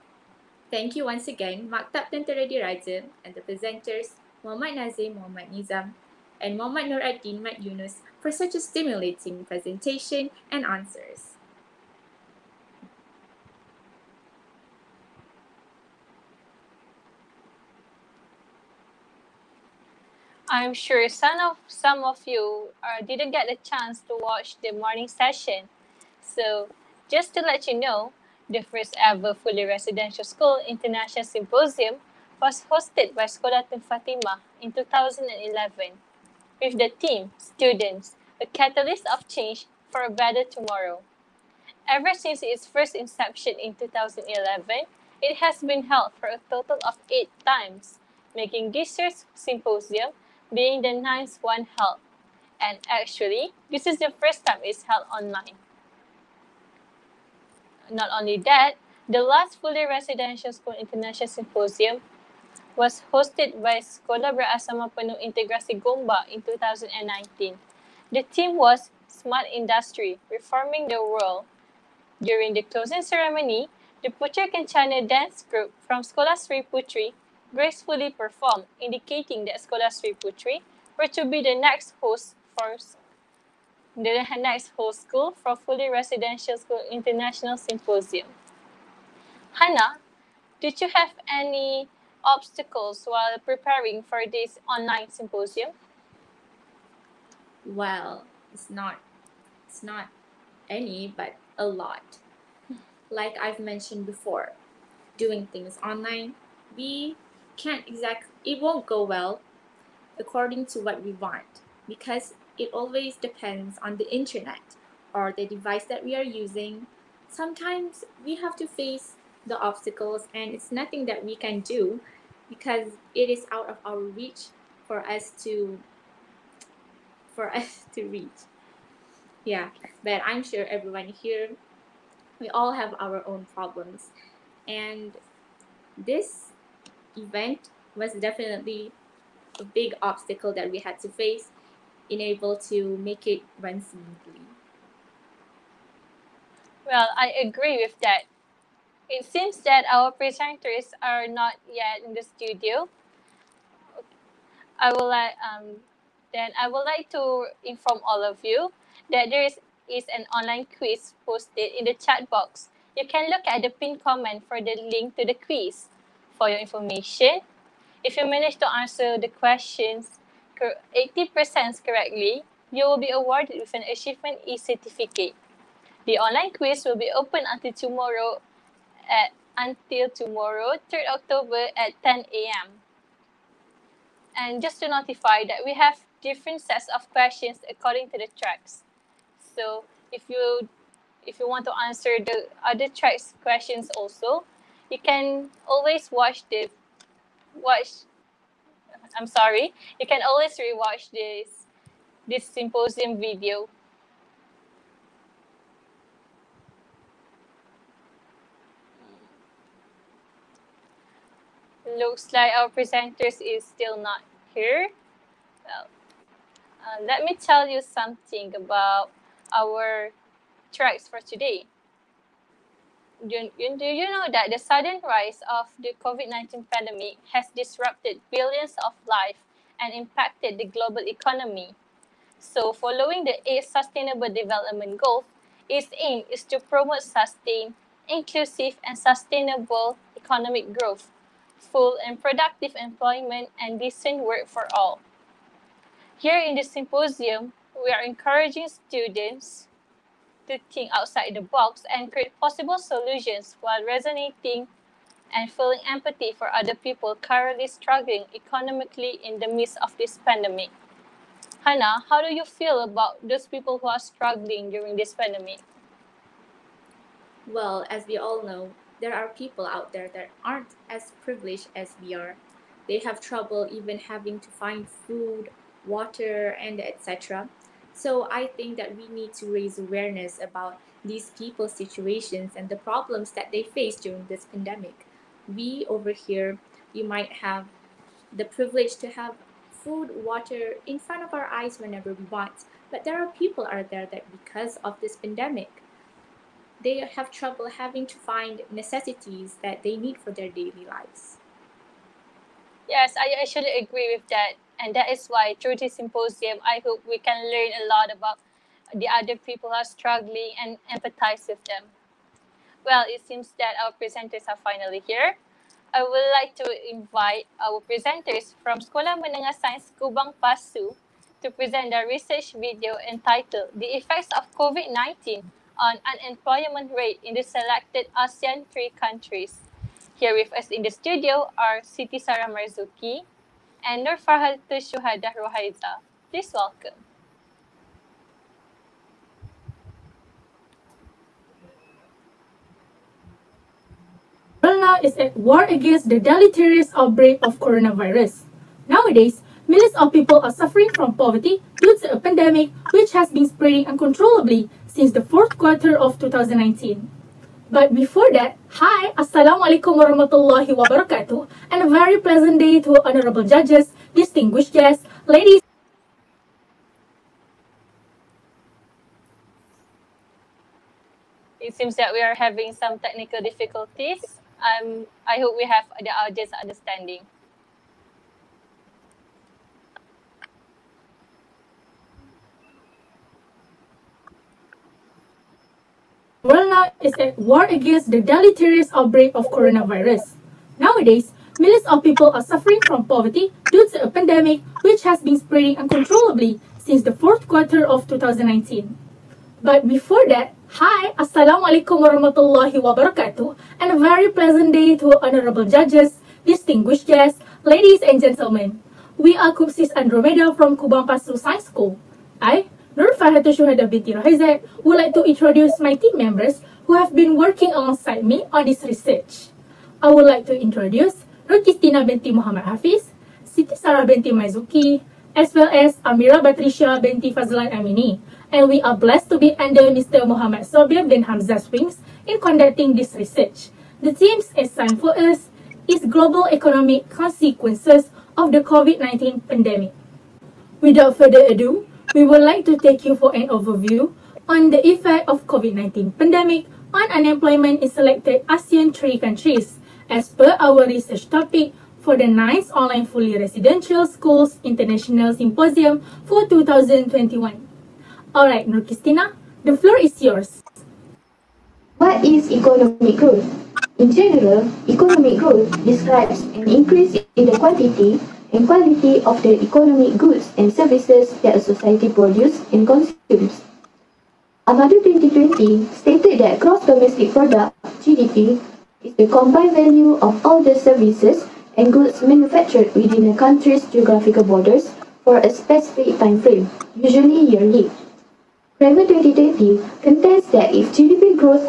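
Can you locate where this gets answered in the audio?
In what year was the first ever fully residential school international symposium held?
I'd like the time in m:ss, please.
0:33.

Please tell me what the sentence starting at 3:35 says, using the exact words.
Well, uh, let me tell you something about our tracks for today.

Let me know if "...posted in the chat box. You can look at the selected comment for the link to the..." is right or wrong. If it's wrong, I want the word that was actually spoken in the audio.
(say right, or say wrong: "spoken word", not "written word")
wrong: "pinned", not "selected".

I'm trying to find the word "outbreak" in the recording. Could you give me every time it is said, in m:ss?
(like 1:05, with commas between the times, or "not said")
5:46, 6:28.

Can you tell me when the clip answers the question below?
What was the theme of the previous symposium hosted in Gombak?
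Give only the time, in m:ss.
1:09.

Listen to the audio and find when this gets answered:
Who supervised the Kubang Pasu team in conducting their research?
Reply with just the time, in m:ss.
7:10.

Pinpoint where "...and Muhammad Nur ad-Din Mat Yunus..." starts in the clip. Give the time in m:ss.
0:06.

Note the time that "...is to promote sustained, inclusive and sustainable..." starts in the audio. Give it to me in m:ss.
3:56.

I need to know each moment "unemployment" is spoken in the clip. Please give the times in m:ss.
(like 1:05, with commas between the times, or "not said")
5:26, 7:27.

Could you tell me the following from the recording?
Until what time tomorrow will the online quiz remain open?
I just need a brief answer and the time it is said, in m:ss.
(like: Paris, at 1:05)
10 a.m., at 3:02.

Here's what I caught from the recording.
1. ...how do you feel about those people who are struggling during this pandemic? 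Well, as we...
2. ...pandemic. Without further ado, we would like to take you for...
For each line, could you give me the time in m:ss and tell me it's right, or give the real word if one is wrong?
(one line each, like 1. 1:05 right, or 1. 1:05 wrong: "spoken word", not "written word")
1. 4:22 right
2. 7:19 right.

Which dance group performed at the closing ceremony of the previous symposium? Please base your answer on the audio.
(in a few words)
Putri Kencana.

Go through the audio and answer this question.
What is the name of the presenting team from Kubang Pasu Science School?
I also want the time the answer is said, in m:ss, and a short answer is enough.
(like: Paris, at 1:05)
Kupsis Andromeda, at 6:49.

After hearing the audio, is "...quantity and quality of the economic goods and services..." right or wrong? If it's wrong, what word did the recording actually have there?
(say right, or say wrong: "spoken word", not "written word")
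right.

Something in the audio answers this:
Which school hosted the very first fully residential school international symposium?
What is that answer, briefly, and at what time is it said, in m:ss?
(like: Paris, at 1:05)
Sekolah Fatima, at 0:33.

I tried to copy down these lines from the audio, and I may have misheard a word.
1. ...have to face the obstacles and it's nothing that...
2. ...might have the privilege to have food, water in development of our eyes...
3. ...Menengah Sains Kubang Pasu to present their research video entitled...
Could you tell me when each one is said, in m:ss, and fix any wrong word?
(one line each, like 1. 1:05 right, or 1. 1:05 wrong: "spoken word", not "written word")
1. 1:58 right
2. 4:47 wrong: "front", not "development"
3. 5:19 right.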